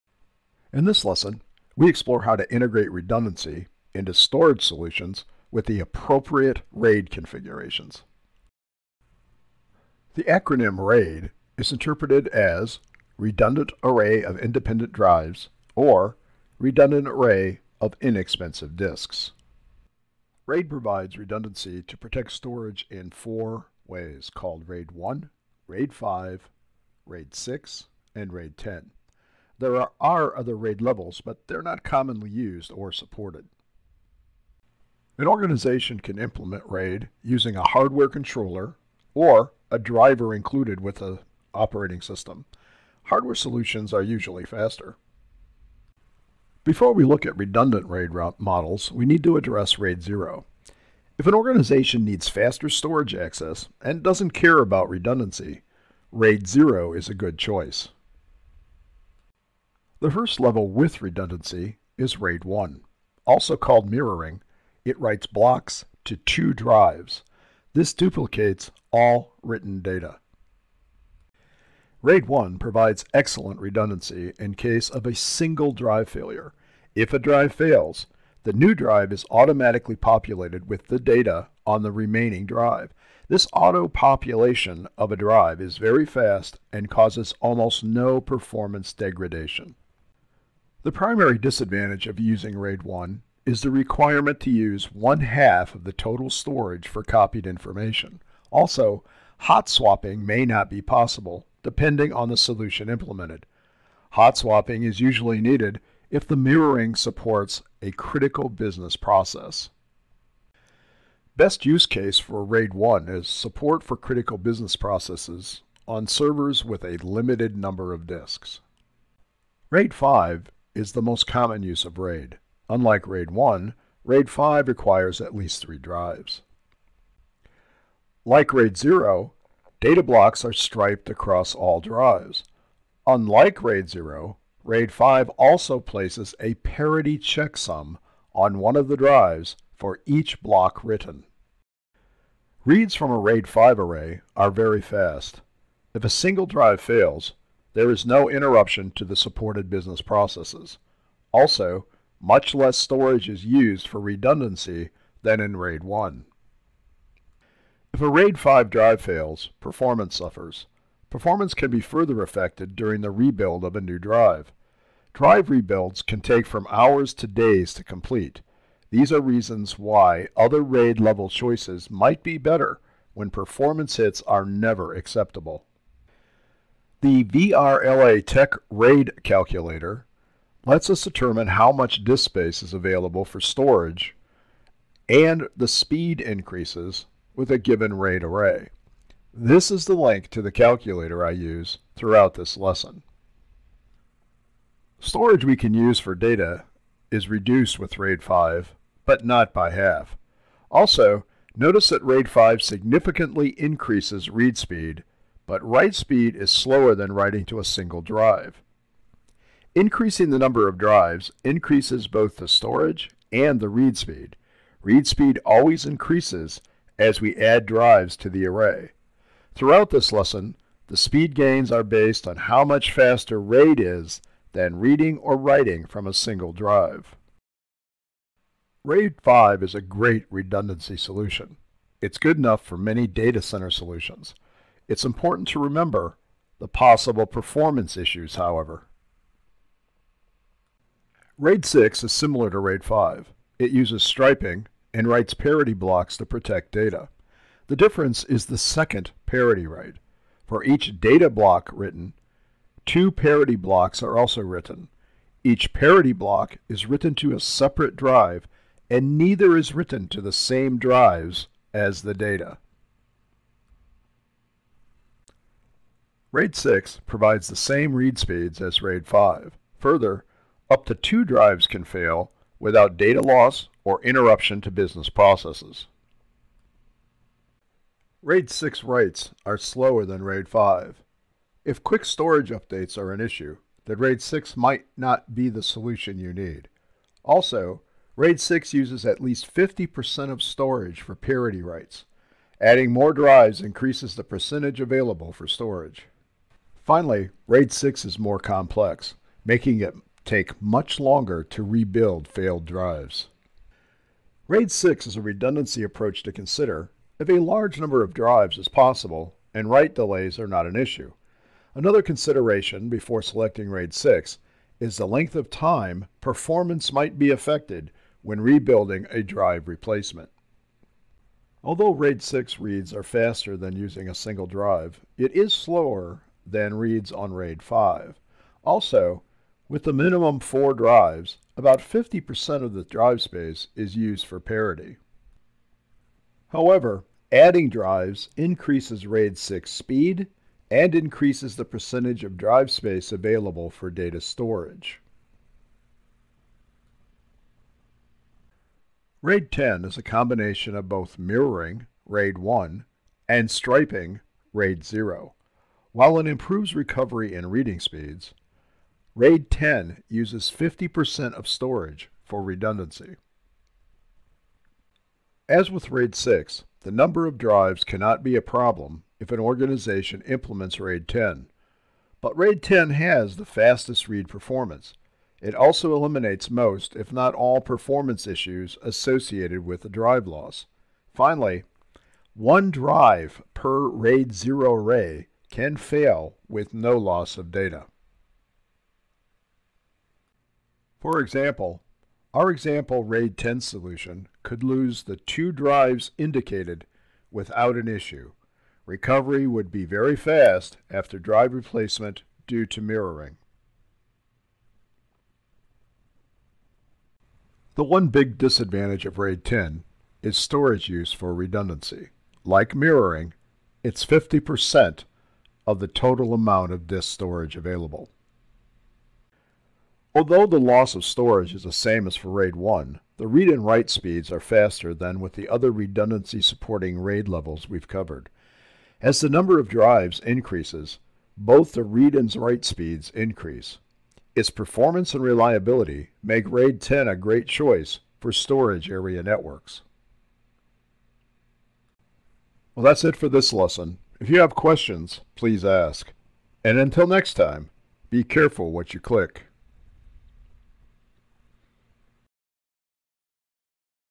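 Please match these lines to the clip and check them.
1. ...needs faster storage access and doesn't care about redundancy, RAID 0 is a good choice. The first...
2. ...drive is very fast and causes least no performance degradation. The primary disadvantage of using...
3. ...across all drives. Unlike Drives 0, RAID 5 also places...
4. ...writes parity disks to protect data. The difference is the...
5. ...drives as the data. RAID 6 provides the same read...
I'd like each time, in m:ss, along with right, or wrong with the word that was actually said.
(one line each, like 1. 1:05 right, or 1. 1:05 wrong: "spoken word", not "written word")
1. 0:52 right
2. 1:25 wrong: "almost", not "least"
3. 2:11 wrong: "RAID", not "Drives"
4. 4:05 wrong: "blocks", not "disks"
5. 4:20 right.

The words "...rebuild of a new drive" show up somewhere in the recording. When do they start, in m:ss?
2:43.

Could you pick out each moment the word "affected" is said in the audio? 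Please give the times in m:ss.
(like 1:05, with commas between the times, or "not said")
2:42, 5:17.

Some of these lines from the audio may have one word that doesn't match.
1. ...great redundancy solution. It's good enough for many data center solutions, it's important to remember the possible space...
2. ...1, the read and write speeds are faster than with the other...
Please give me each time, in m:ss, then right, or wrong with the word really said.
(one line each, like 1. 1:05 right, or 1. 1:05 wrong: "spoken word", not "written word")
1. 3:49 wrong: "performance", not "space"
2. 7:02 right.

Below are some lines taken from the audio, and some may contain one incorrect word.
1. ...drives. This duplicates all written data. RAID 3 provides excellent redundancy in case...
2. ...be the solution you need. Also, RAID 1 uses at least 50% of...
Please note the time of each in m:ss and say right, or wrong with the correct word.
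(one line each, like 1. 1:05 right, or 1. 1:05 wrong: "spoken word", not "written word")
1. 1:06 wrong: "1", not "3"
2. 4:45 wrong: "6", not "1".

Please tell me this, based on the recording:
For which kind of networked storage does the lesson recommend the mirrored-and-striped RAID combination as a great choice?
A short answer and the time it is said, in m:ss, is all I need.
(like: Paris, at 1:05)
Storage area networks, at 7:18.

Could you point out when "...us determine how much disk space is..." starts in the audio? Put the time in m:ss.
3:00.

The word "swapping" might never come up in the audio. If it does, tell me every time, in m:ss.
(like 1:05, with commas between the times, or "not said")
1:39, 1:44.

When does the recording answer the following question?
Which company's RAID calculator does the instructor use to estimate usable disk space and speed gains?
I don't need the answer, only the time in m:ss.
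2:57.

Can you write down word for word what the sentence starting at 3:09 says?
This is the link to the calculator I use throughout this lesson.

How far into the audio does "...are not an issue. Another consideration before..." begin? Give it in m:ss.
5:10.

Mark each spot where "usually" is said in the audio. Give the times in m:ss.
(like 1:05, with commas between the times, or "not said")
0:44, 1:44.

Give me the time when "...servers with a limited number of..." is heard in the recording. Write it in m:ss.
1:56.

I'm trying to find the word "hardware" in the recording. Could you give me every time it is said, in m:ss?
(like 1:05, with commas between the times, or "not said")
0:37, 0:43.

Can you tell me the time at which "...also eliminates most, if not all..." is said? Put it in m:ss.
6:15.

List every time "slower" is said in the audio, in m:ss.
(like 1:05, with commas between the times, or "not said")
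3:26, 4:39, 5:25.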